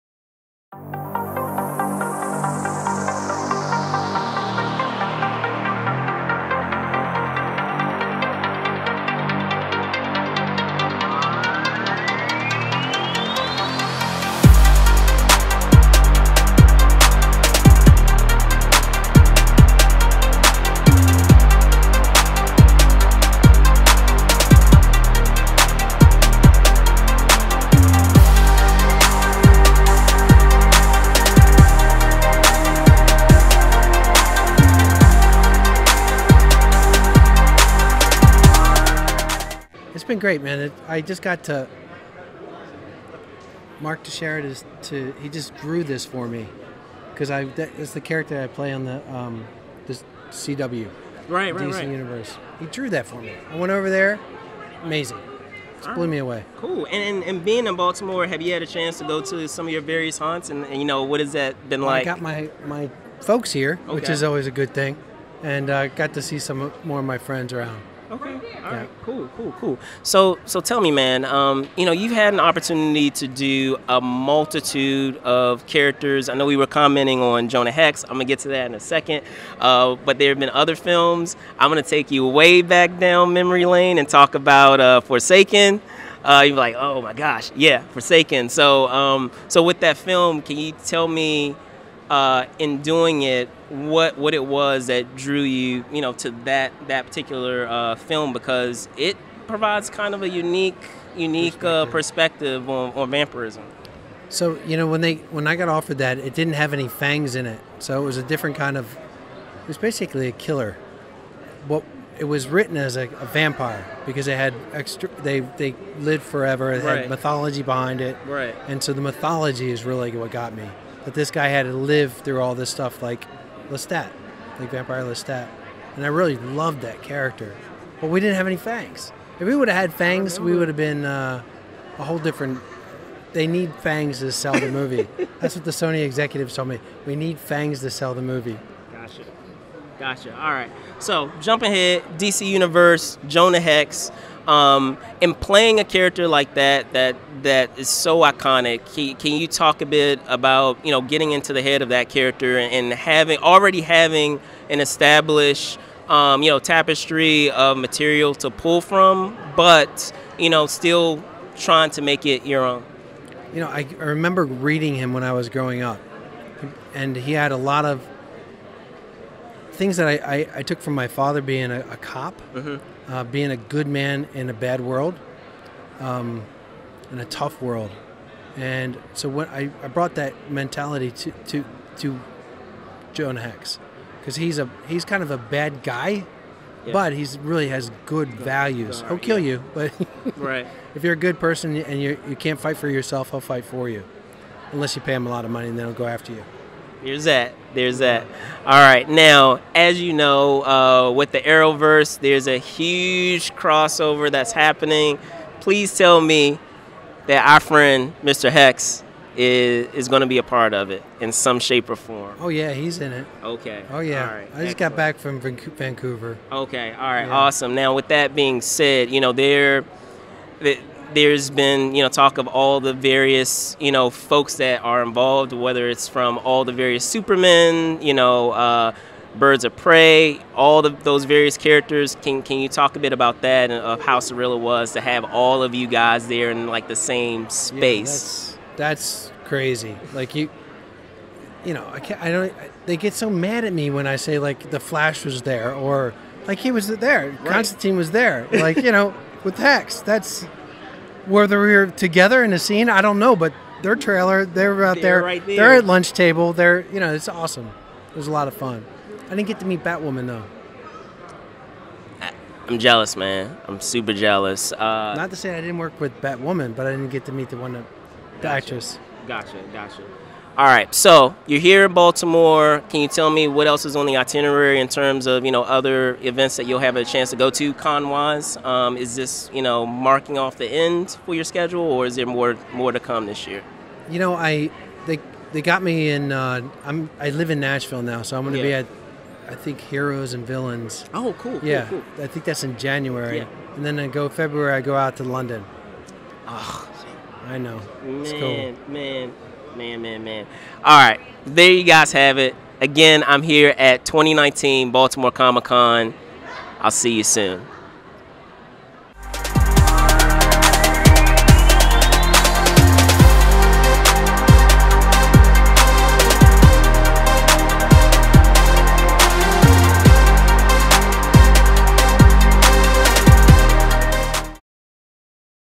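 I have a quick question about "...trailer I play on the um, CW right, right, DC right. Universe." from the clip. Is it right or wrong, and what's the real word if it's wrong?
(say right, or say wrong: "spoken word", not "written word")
wrong: "character", not "trailer".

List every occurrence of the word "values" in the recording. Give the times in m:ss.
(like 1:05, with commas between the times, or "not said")
3:08.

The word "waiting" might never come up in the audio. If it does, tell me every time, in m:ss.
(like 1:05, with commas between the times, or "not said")
not said.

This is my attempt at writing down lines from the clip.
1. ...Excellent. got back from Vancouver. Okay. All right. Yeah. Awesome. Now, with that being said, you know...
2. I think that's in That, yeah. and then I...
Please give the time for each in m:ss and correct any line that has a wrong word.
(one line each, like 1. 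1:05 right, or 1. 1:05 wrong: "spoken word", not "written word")
1. 3:34 right
2. 4:52 wrong: "January", not "That".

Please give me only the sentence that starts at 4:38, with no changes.
Um, is this you know marking off the end for your schedule, or is there more more to come this year?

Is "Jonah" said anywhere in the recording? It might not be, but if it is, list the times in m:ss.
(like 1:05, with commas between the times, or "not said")
1:17, 2:23.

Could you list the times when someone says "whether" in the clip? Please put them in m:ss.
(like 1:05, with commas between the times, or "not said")
3:45, 4:11.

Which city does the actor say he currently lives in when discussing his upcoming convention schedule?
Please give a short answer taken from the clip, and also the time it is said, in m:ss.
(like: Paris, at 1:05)
Nashville, at 4:47.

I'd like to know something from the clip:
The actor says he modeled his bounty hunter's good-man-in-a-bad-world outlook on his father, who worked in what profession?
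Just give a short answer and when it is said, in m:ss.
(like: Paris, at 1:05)
Cop, at 2:51.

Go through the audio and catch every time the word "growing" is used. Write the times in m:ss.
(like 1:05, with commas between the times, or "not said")
2:45.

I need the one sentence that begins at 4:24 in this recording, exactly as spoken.
Uh, Not to say I didn't work with Batwoman, but I didn't get to meet the one that, the gotcha.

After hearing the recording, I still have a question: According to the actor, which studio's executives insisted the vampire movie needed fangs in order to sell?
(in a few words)
Sony.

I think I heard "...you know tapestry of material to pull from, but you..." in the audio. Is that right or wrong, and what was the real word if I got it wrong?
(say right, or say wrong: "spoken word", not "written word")
right.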